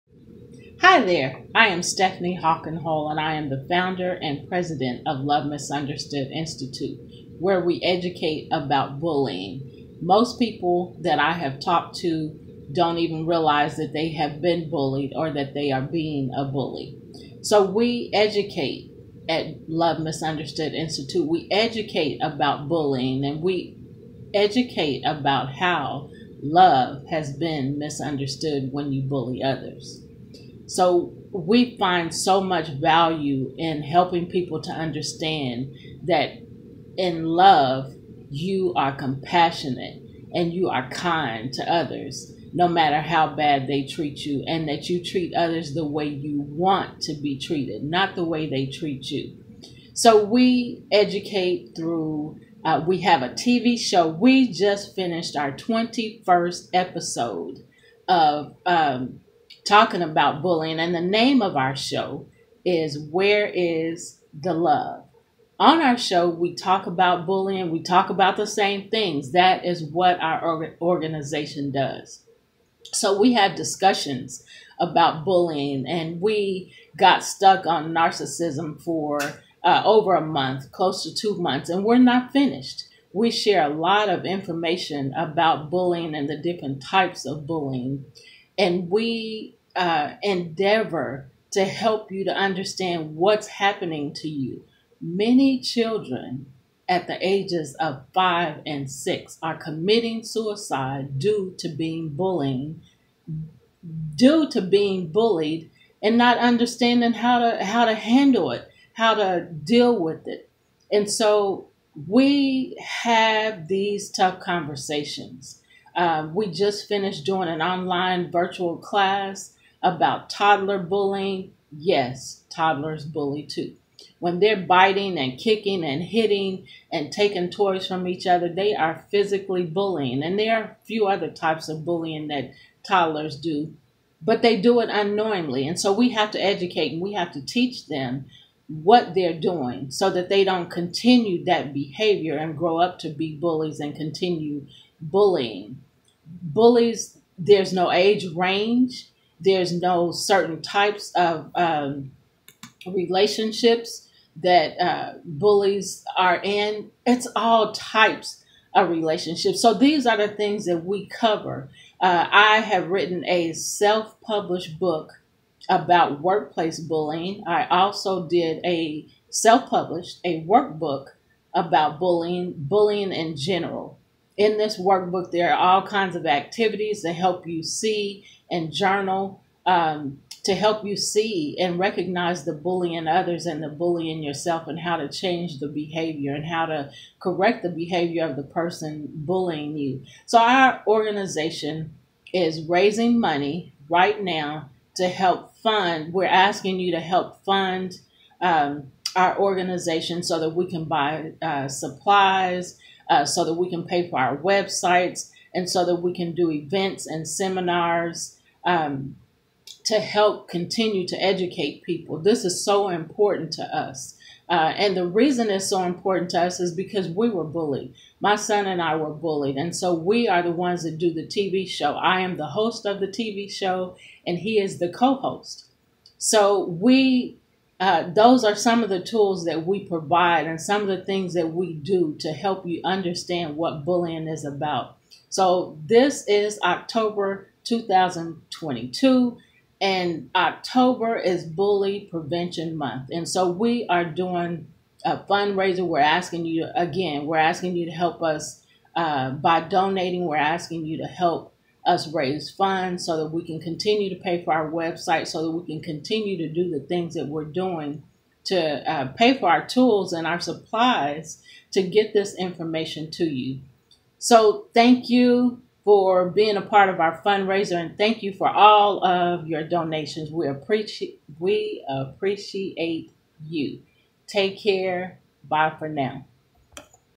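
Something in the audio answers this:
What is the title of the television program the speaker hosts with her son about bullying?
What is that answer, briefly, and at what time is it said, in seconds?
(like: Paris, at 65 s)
Where is the Love?, at 62 s.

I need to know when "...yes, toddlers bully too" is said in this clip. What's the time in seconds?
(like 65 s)
121 s.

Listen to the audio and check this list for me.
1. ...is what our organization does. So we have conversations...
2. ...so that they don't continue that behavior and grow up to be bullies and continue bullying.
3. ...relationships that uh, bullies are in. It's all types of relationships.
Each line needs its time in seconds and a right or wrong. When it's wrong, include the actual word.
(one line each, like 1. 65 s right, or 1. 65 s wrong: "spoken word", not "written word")
1. 69 s wrong: "discussions", not "conversations"
2. 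139 s right
3. 152 s right.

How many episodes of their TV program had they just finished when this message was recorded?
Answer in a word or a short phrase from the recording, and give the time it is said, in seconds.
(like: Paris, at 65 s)
21, at 55 s.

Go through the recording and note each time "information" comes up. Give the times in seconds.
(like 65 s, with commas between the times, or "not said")
84 s, 262 s.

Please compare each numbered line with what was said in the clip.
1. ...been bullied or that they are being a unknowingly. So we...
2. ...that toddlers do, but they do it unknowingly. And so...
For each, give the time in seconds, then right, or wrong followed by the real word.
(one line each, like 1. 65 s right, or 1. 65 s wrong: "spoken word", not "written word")
1. 14 s wrong: "bully", not "unknowingly"
2. 132 s right.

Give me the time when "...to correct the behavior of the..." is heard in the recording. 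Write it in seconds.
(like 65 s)
186 s.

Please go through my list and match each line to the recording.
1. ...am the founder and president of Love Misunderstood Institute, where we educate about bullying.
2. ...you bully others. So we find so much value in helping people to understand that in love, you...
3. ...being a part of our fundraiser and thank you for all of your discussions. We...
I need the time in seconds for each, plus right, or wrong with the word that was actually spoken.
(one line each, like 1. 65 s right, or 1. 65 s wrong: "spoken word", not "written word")
1. 3 s right
2. 28 s right
3. 266 s wrong: "donations", not "discussions".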